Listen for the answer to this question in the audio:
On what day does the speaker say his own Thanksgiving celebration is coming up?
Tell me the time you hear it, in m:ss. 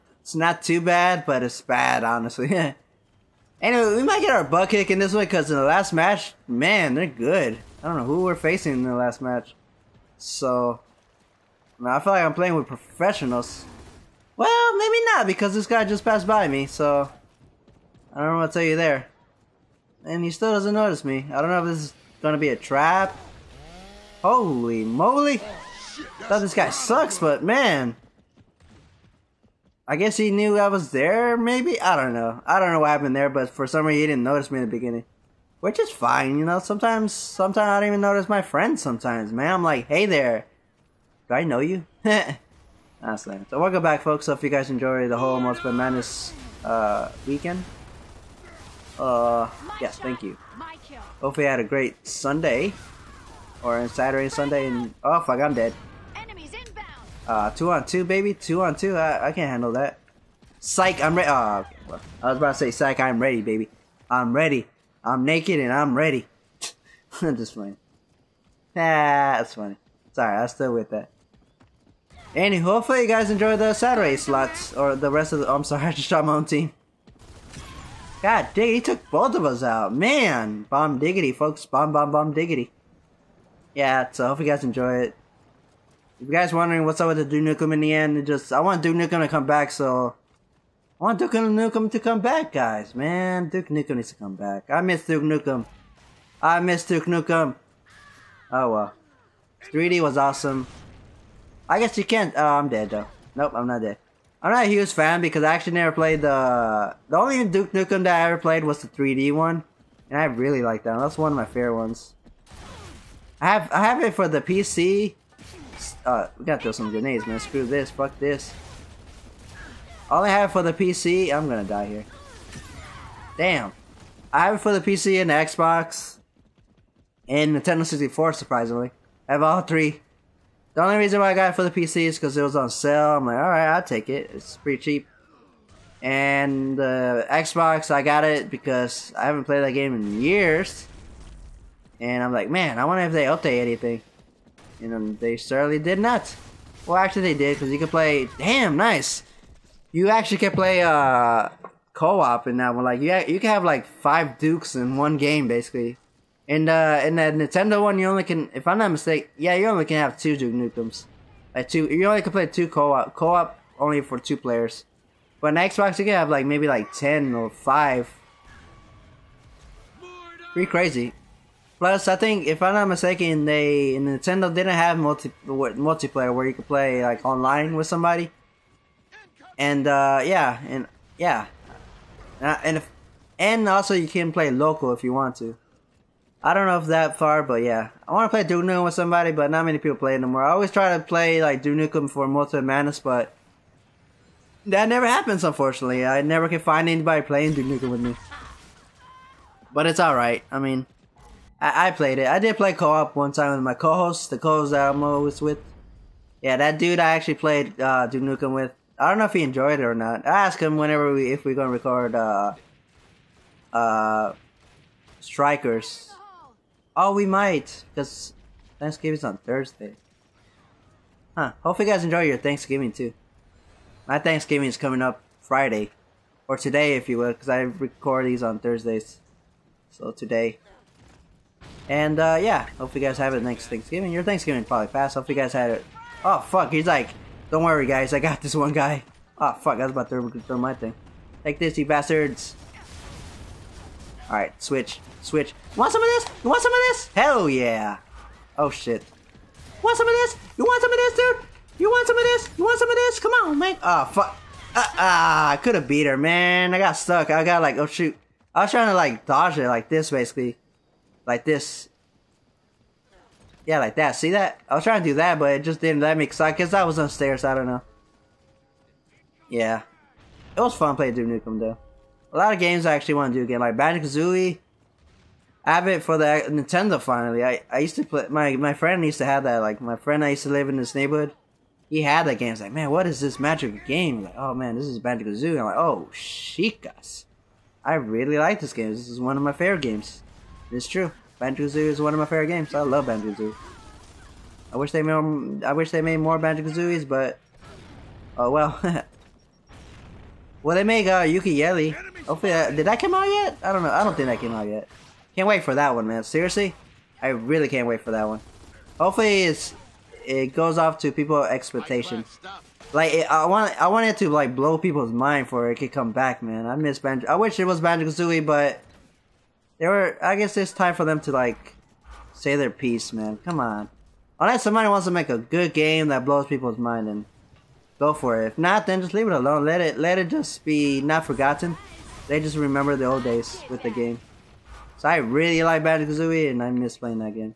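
3:45.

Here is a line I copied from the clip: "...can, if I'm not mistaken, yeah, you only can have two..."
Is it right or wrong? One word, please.
right.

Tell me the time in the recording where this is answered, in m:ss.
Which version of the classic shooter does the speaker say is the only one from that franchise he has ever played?
1:48.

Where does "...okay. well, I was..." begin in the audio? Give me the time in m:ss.
1:01.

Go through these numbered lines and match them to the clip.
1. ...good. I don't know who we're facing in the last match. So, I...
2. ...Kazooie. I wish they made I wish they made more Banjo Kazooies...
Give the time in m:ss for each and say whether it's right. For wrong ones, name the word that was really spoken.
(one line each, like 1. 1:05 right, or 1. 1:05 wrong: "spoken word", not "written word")
1. 0:07 right
2. 4:53 right.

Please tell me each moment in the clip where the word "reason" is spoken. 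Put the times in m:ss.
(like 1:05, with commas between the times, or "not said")
0:33, 2:10.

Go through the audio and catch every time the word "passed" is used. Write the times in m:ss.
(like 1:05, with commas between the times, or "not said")
0:16, 3:54.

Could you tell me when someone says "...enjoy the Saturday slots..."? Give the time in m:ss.
1:13.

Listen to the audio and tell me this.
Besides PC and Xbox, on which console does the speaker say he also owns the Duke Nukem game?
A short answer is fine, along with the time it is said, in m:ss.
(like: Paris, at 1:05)
Nintendo 64, at 2:07.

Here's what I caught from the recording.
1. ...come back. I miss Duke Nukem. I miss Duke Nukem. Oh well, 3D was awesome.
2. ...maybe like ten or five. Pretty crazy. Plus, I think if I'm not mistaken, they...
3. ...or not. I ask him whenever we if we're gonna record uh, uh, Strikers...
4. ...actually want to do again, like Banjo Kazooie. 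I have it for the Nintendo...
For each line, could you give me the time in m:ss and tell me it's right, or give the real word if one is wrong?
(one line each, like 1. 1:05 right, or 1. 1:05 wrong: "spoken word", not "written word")
1. 1:34 right
2. 2:46 right
3. 3:29 right
4. 4:32 right.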